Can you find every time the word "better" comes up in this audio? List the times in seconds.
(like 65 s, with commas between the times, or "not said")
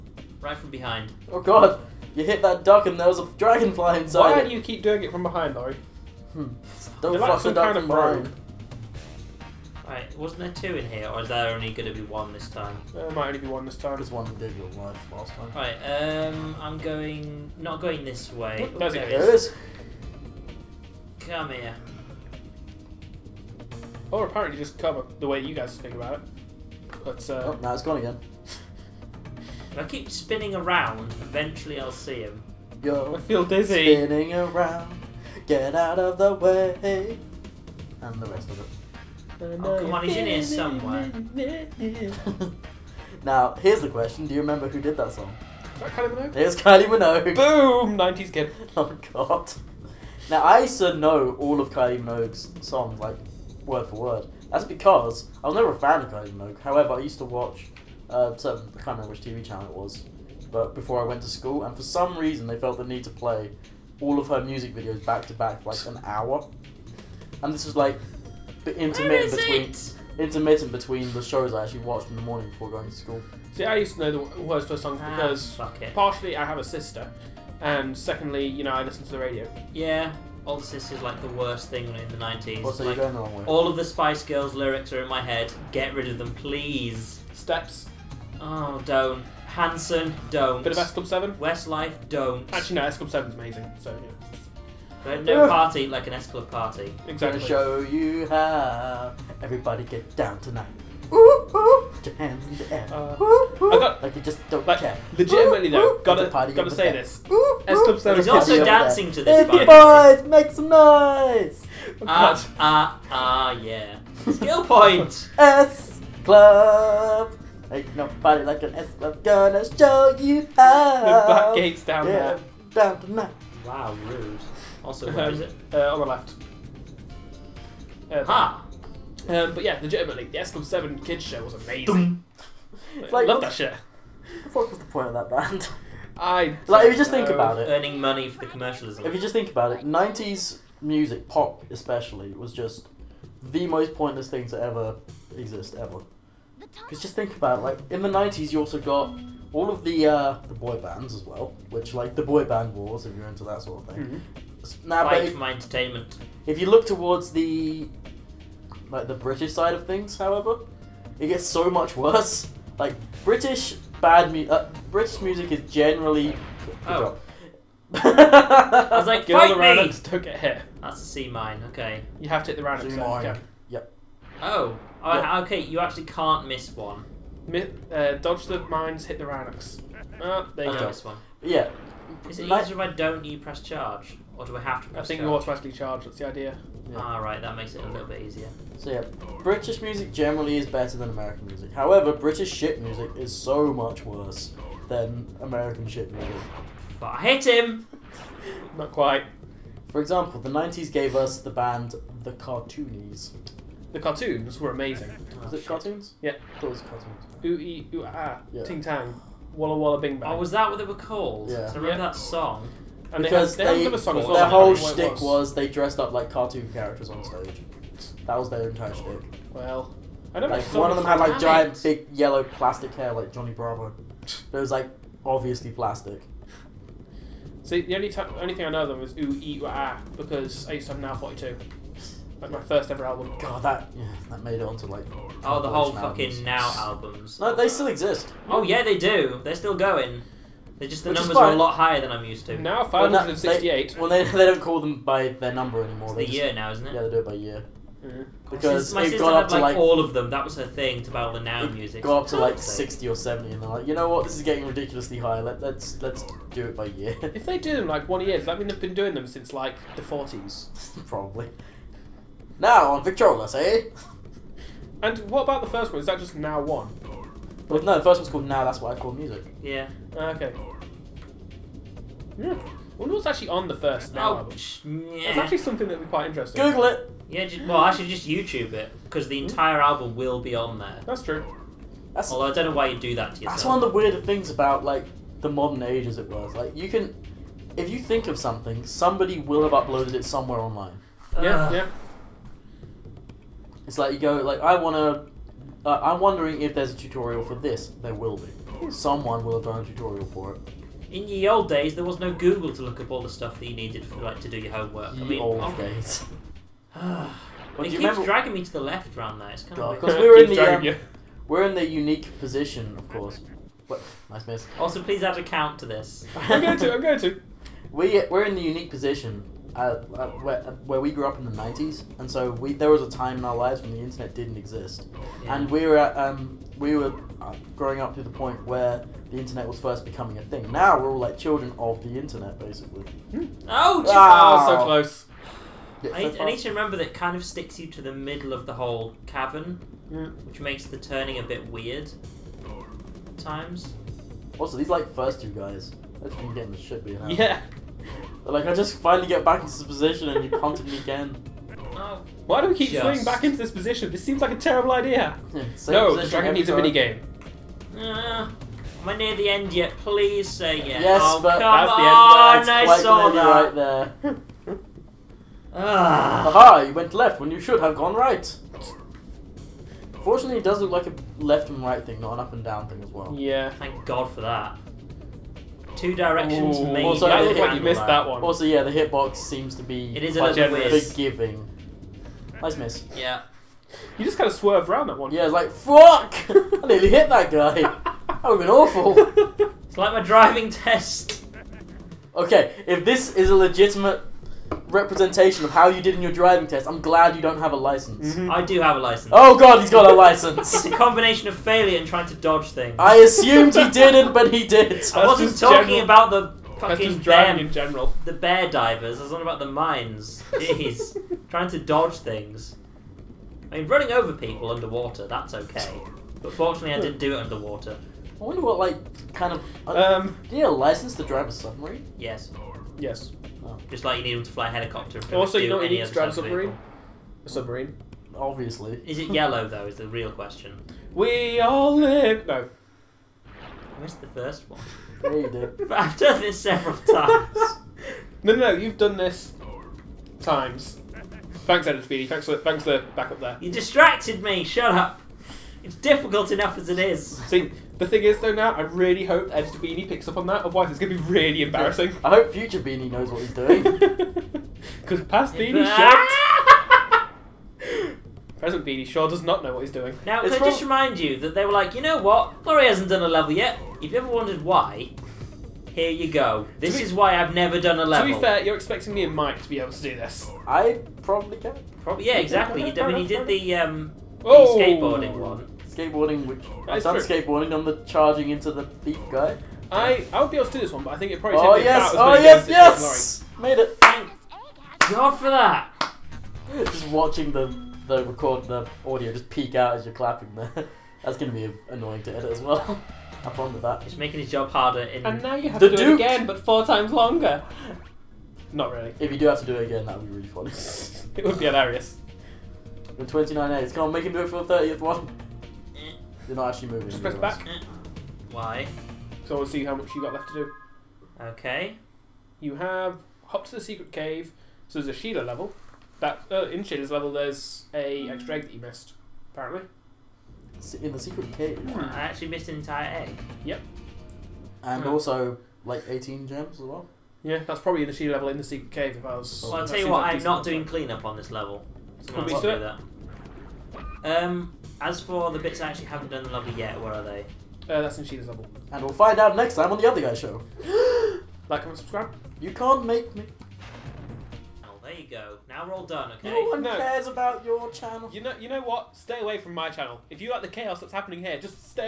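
190 s.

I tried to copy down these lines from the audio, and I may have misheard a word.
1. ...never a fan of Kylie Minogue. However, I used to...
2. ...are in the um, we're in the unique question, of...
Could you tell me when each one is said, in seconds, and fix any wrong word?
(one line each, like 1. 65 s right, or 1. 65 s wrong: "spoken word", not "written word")
1. 55 s right
2. 310 s wrong: "position", not "question".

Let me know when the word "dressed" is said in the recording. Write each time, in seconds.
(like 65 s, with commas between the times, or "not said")
215 s.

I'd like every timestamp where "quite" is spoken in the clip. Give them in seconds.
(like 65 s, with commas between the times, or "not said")
198 s, 276 s.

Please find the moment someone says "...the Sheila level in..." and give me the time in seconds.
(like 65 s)
528 s.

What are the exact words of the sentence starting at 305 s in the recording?
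Ye I mean, old oh, days.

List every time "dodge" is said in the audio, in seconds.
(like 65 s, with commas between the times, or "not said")
178 s, 402 s, 411 s.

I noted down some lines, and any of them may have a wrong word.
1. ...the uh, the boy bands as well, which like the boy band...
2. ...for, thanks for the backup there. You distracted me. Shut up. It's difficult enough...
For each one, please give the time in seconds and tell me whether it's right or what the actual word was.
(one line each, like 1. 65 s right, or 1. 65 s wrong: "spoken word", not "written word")
1. 149 s right
2. 442 s right.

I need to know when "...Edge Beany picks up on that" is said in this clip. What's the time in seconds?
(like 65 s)
449 s.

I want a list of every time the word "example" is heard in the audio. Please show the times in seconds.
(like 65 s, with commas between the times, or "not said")
199 s.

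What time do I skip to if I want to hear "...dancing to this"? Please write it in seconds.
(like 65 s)
108 s.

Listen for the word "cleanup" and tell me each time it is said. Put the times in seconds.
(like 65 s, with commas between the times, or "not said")
530 s.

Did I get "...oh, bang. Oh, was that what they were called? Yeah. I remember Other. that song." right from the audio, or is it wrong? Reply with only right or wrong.
wrong.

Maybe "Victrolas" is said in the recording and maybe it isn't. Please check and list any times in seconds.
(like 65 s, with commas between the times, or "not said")
263 s.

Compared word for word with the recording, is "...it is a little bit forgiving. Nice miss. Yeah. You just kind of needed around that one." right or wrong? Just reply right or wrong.
wrong.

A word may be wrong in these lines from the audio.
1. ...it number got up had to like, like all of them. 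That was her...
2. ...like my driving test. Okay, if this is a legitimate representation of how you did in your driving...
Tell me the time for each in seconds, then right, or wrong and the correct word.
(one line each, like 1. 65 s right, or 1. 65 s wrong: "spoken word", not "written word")
1. 249 s wrong: "sister", not "number"
2. 389 s right.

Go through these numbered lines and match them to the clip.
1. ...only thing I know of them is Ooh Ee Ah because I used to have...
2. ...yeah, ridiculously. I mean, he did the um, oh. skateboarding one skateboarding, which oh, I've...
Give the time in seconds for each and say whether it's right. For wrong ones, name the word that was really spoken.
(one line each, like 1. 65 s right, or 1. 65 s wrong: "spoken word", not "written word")
1. 228 s right
2. 472 s wrong: "exactly", not "ridiculously".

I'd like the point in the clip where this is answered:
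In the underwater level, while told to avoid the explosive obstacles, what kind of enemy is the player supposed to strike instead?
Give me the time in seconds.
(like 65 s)
179 s.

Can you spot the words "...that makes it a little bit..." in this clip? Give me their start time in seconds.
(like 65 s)
187 s.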